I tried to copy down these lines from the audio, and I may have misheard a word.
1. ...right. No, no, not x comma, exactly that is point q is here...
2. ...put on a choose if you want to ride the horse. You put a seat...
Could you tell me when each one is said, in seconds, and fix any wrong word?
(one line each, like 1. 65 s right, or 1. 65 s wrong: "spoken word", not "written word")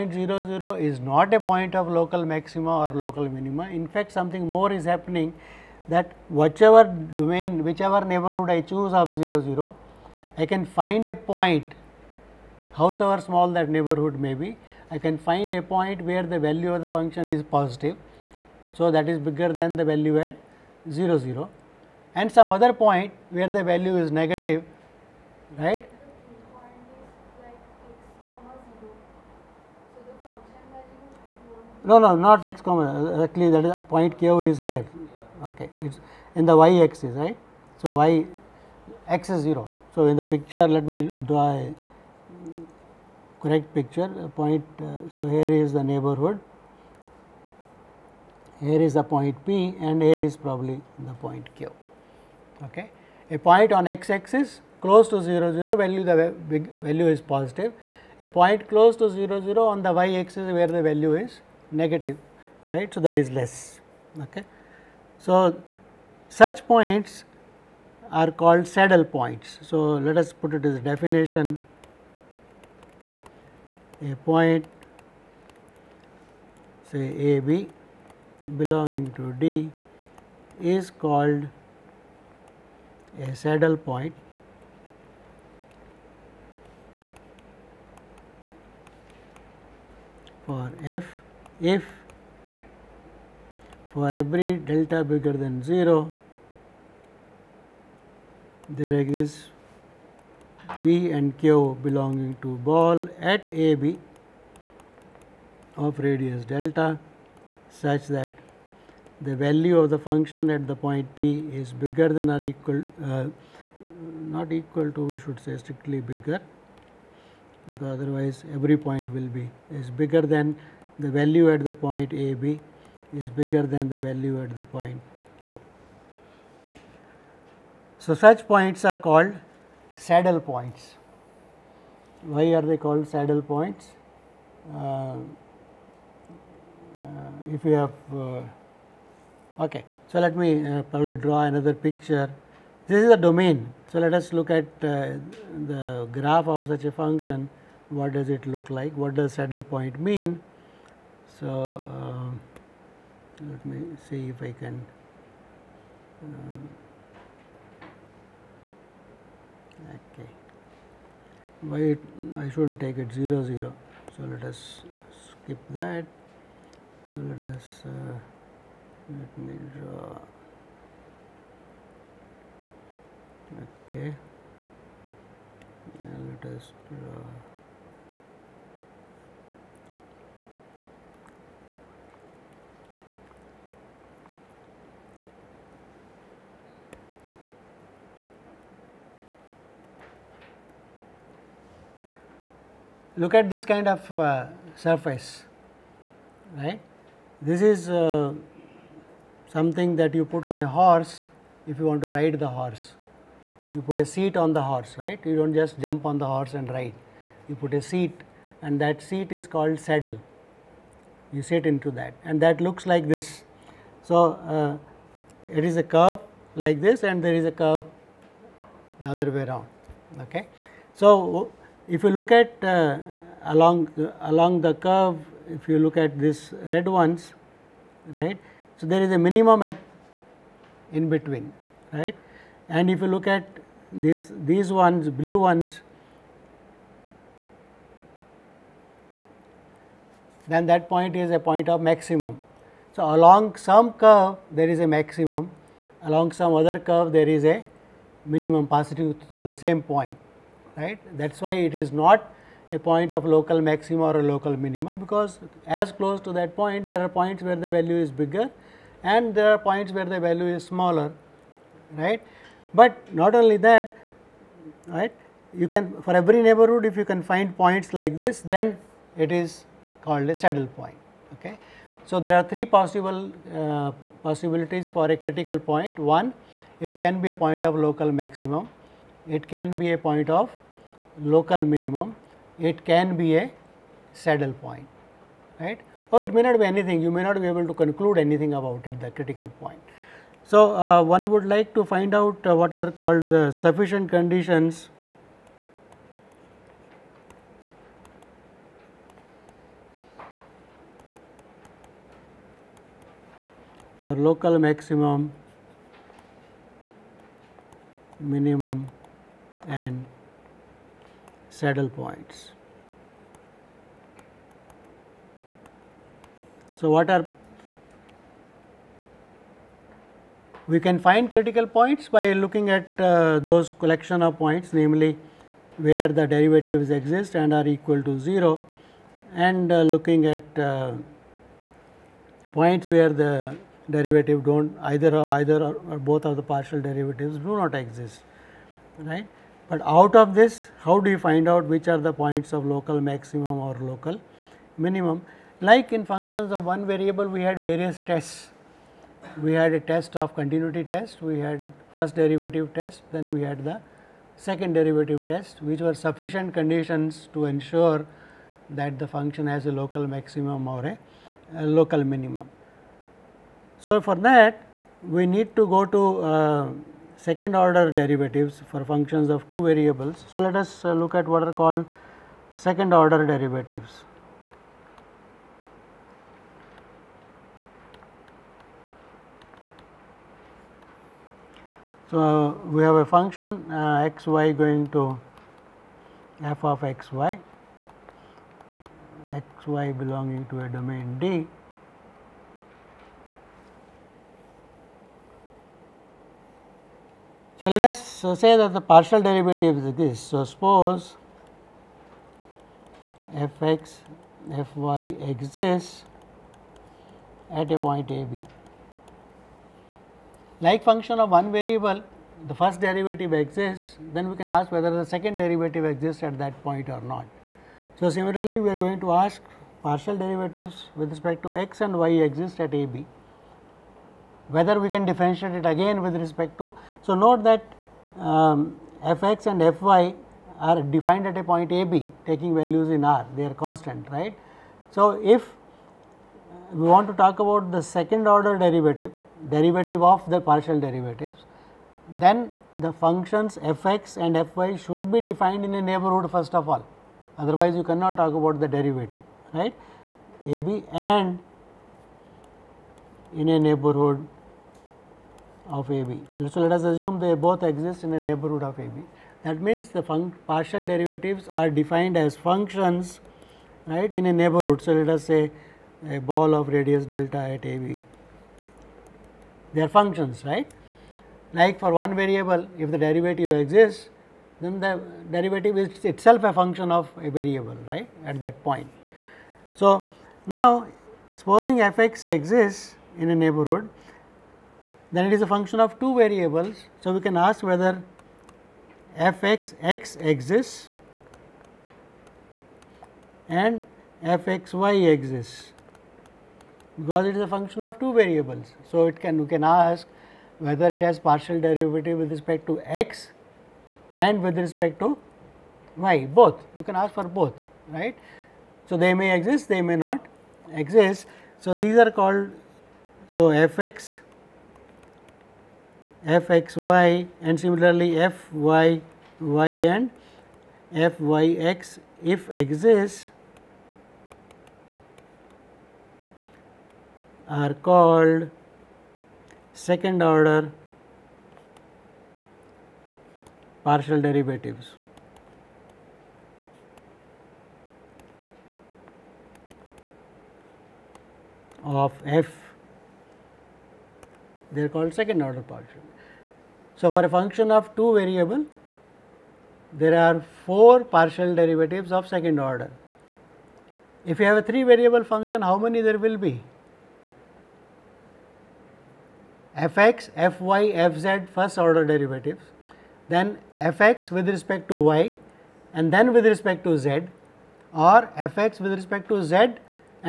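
1. 25 s right
2. 200 s wrong: "horse", not "choose".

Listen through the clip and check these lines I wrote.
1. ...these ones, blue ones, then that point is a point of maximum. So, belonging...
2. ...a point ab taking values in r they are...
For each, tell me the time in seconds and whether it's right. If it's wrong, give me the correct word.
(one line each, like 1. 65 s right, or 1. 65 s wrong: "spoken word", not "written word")
1. 234 s wrong: "along", not "belonging"
2. 431 s right.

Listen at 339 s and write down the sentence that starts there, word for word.
But out of this, how do you find out which are the points of local maximum or local minimum?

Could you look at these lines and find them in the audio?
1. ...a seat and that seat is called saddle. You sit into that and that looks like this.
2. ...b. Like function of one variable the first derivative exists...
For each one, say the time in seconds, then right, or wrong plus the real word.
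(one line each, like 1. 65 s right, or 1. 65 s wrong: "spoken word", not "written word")
1. 207 s right
2. 408 s right.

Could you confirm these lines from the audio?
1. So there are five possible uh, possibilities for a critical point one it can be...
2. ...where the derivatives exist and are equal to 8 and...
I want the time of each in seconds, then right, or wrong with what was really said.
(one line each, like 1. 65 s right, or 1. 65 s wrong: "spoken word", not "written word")
1. 272 s wrong: "three", not "five"
2. 325 s wrong: "0", not "8".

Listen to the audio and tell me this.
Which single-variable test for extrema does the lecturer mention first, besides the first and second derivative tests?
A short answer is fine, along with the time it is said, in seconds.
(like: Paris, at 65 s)
continuity test, at 350 s.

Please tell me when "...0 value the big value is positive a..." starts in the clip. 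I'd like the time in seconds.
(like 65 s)
55 s.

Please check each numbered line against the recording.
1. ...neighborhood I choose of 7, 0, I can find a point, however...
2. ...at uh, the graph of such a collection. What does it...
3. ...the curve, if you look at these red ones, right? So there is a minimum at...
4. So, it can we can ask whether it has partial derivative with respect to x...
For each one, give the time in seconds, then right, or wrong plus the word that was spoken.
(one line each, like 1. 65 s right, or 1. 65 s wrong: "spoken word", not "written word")
1. 8 s wrong: "0", not "7"
2. 144 s wrong: "function", not "collection"
3. 224 s right
4. 498 s right.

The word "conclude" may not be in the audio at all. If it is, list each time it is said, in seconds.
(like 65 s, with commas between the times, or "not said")
287 s.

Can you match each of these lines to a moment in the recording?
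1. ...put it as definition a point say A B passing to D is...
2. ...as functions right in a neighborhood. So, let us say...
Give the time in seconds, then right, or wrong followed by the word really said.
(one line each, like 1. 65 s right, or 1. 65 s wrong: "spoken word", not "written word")
1. 70 s wrong: "belonging", not "passing"
2. 462 s right.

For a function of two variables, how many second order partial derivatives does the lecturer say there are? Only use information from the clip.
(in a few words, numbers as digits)
4.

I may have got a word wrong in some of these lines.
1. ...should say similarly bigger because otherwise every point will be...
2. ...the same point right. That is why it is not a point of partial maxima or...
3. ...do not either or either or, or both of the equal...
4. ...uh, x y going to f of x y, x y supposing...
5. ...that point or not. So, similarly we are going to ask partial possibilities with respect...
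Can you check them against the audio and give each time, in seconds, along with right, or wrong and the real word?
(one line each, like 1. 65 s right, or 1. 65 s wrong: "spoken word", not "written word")
1. 115 s wrong: "strictly", not "similarly"
2. 249 s wrong: "local", not "partial"
3. 334 s wrong: "partial", not "equal"
4. 383 s wrong: "belonging", not "supposing"
5. 416 s wrong: "derivatives", not "possibilities".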